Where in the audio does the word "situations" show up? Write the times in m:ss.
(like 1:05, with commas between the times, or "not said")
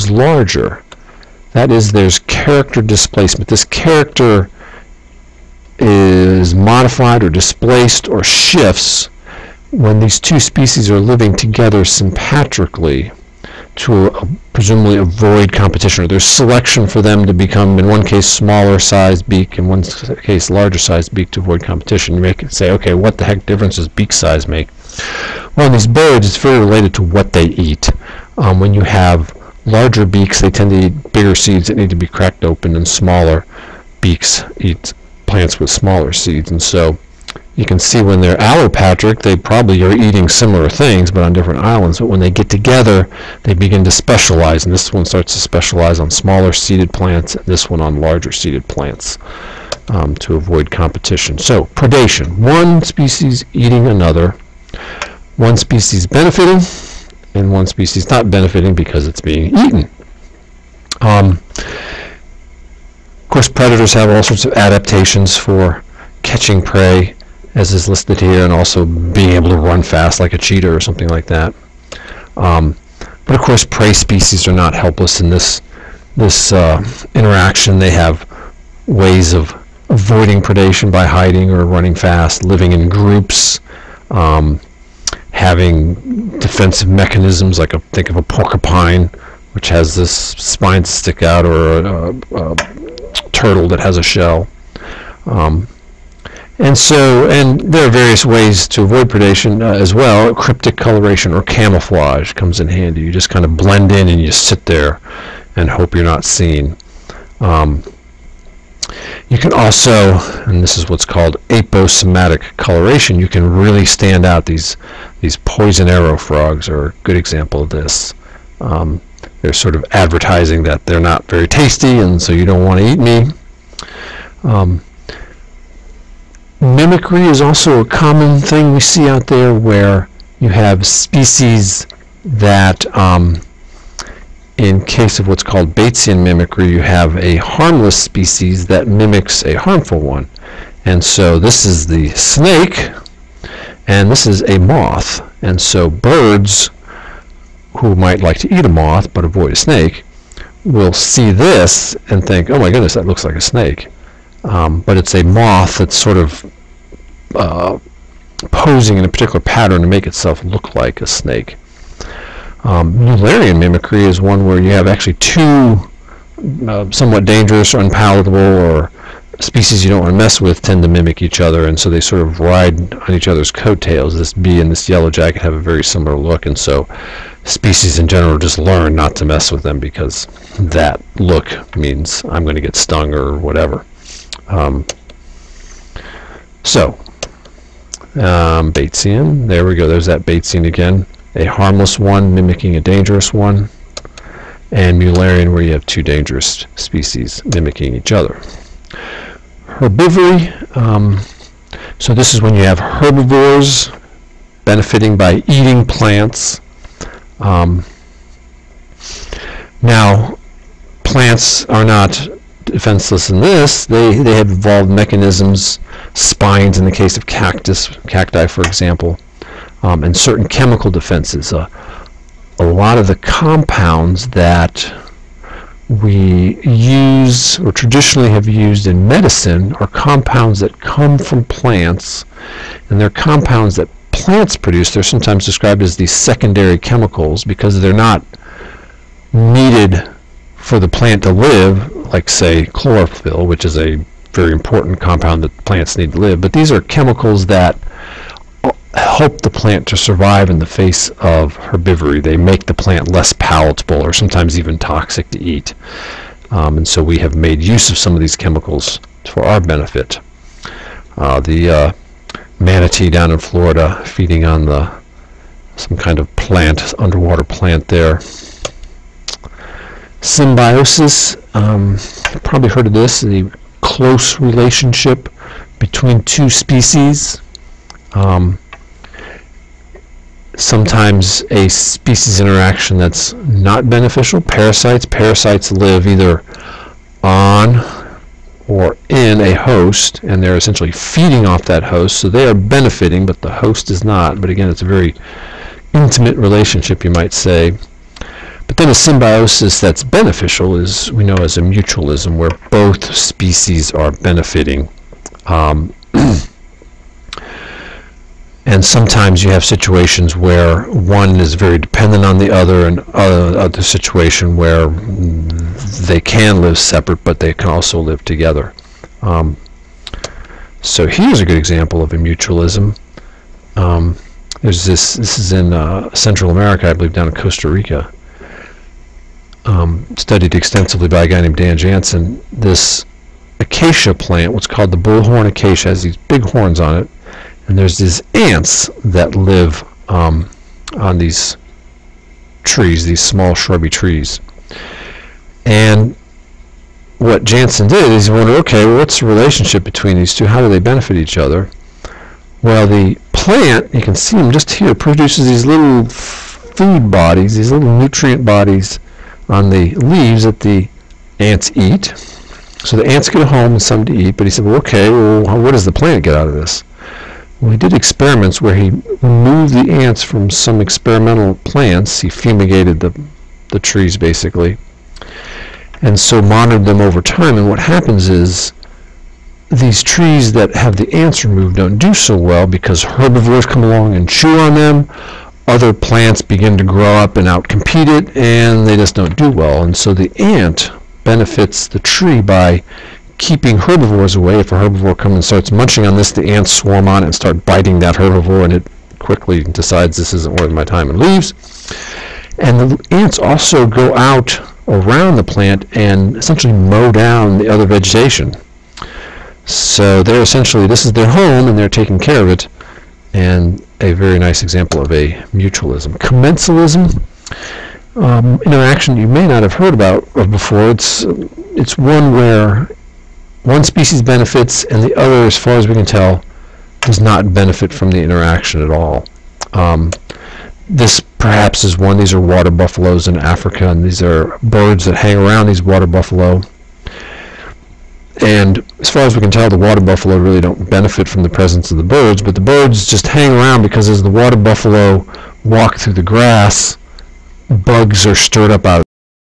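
5:09, 5:13.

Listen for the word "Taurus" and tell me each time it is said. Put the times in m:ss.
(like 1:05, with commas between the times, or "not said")
not said.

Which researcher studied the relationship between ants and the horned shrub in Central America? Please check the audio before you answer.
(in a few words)
Dan Janzen.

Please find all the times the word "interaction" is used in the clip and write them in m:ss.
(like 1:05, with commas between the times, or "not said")
1:17, 4:42, 6:58, 7:08.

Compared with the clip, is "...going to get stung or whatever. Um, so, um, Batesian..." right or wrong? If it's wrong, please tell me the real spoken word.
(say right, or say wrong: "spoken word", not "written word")
right.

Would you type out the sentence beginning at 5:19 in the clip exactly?
Um, so here's a good example of a mutualism.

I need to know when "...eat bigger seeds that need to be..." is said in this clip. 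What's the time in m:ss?
0:30.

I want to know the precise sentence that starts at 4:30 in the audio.
Symbiosis, um, probably heard of this, the close relationship between two species.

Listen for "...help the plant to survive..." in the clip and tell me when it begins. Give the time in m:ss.
4:08.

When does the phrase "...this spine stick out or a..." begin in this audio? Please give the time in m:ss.
1:29.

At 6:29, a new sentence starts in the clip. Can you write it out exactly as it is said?
And so the ant benefits the tree by keeping herbivores away.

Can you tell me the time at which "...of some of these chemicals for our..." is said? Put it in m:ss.
4:17.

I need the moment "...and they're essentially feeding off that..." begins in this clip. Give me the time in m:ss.
4:50.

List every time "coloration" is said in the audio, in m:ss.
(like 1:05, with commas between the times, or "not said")
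1:40, 1:52.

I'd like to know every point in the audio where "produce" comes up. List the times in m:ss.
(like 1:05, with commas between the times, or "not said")
3:54, 5:54.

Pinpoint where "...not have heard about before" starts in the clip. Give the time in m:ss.
6:59.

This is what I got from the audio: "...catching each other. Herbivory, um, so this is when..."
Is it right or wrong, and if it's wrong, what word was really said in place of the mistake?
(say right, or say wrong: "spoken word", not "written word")
wrong: "mimicking", not "catching".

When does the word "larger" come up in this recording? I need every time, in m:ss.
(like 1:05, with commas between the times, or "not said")
0:00, 0:20, 0:29, 0:48.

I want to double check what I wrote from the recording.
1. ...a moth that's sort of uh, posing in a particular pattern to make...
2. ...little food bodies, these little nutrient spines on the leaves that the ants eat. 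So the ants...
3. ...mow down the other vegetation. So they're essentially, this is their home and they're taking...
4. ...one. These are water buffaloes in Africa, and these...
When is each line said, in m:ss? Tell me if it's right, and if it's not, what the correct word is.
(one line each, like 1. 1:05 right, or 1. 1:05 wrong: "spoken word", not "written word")
1. 2:35 right
2. 5:55 wrong: "bodies", not "spines"
3. 6:46 right
4. 7:11 right.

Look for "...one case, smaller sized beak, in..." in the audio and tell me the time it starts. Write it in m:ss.
0:17.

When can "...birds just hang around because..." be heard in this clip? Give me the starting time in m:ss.
7:22.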